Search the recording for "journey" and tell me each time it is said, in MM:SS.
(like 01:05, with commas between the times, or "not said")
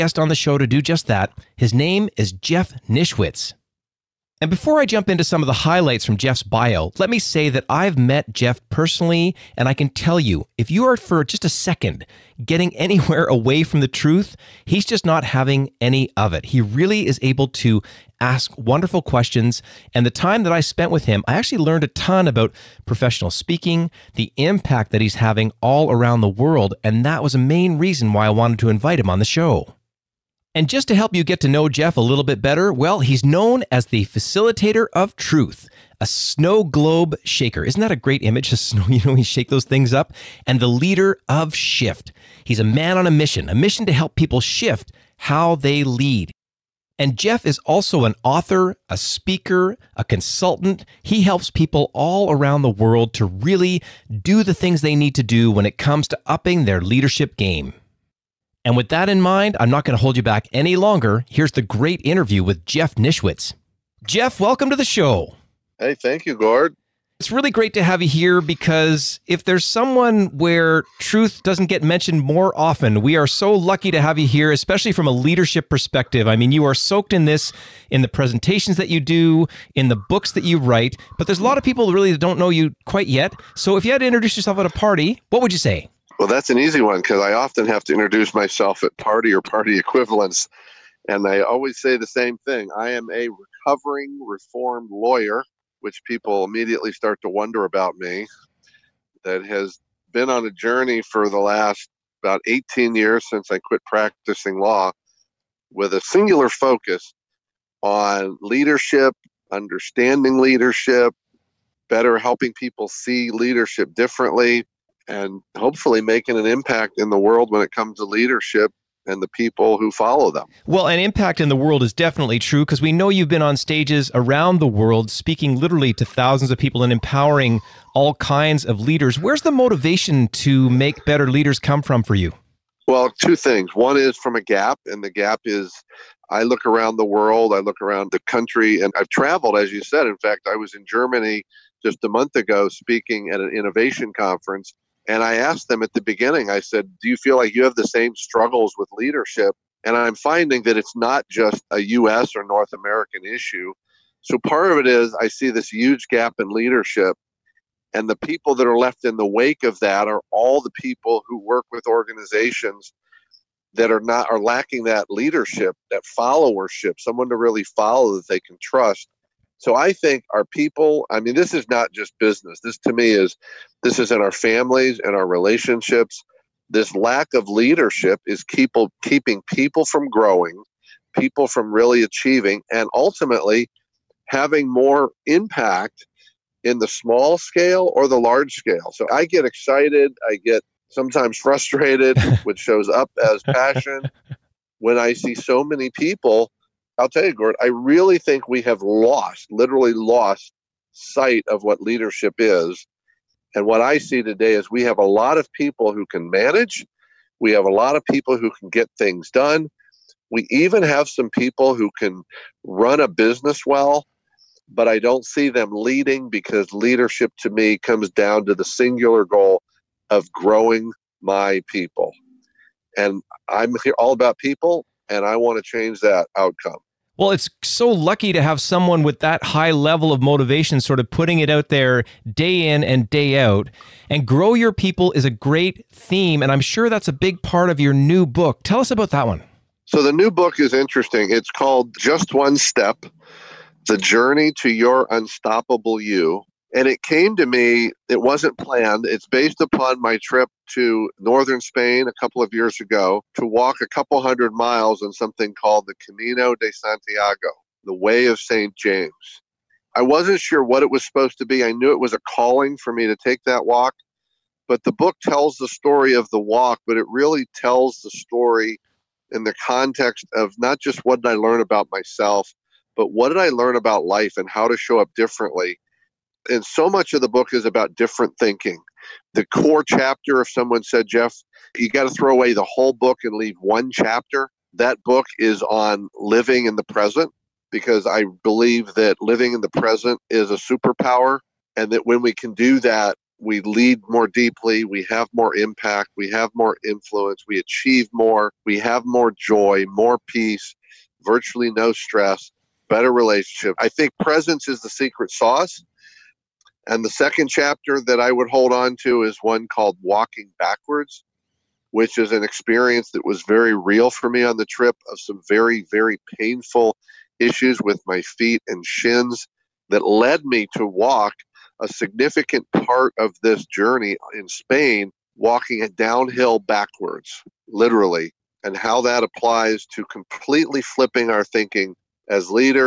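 01:40, 04:03, 05:23.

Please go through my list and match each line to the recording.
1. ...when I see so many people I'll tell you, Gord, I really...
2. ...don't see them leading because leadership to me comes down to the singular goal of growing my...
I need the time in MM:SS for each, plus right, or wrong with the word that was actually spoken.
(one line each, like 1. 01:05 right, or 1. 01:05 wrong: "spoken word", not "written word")
1. 03:14 right
2. 03:34 right.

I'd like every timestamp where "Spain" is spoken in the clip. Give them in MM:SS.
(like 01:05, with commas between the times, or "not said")
04:11, 05:24.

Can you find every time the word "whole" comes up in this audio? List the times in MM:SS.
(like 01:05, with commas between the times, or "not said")
04:42.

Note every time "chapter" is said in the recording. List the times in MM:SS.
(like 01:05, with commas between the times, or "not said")
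04:39, 04:43, 05:07.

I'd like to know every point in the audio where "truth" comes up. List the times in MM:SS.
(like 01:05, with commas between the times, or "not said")
00:13, 00:35, 01:10.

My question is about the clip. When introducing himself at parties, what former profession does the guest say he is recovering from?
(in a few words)
lawyer.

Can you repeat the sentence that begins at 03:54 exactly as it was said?
And grow your people is a great theme.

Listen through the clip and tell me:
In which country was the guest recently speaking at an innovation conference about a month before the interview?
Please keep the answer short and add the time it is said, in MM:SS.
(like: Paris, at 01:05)
Germany, at 02:20.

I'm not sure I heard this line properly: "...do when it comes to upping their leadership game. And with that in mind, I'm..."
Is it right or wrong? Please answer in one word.
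right.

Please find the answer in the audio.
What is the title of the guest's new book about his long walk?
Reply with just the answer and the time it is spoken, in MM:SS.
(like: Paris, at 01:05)
Just One Step, at 04:01.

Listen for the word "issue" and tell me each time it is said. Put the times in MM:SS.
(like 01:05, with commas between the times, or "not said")
02:33, 05:17.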